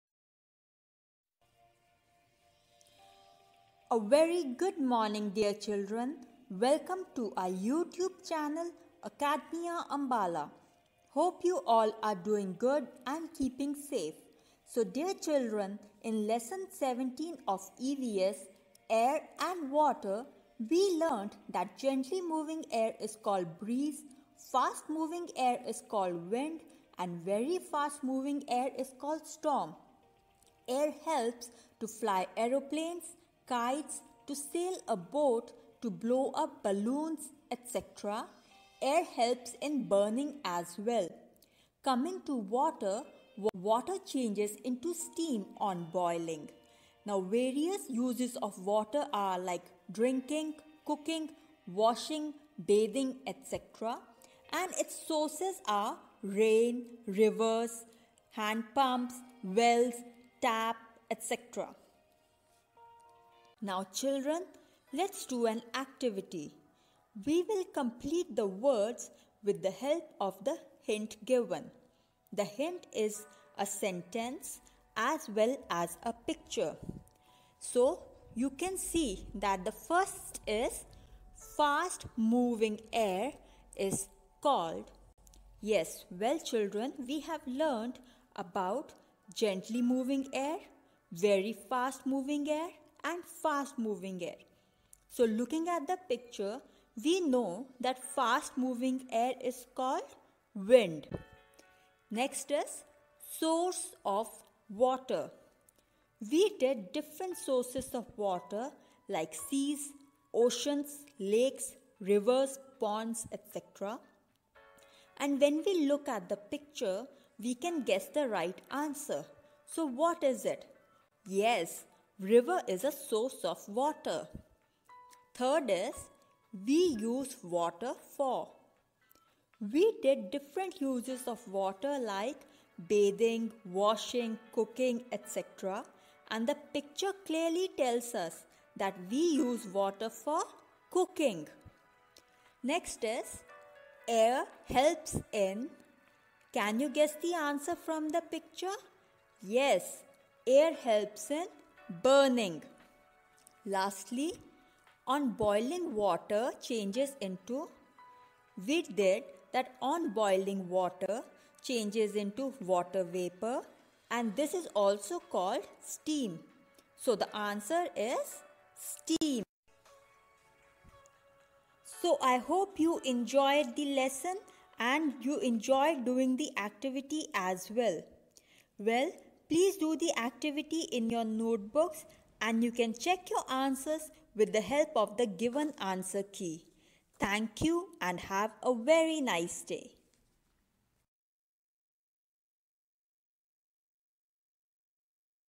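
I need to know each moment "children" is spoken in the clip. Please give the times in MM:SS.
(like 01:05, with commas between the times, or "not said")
00:05, 00:15, 01:03, 01:26.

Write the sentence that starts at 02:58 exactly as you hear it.
Well, Please do the activity in your notebooks and you can check your answers with the help of the given answer key.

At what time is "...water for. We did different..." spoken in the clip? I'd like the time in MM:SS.
02:07.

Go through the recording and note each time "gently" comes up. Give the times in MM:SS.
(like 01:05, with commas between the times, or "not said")
00:21, 01:29.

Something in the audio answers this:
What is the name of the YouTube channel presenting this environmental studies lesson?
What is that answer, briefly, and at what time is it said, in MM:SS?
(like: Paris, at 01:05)
Academia Ambala, at 00:09.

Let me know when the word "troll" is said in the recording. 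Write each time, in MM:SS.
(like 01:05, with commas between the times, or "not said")
not said.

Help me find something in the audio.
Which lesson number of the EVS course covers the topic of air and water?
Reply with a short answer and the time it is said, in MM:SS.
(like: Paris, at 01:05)
17, at 00:16.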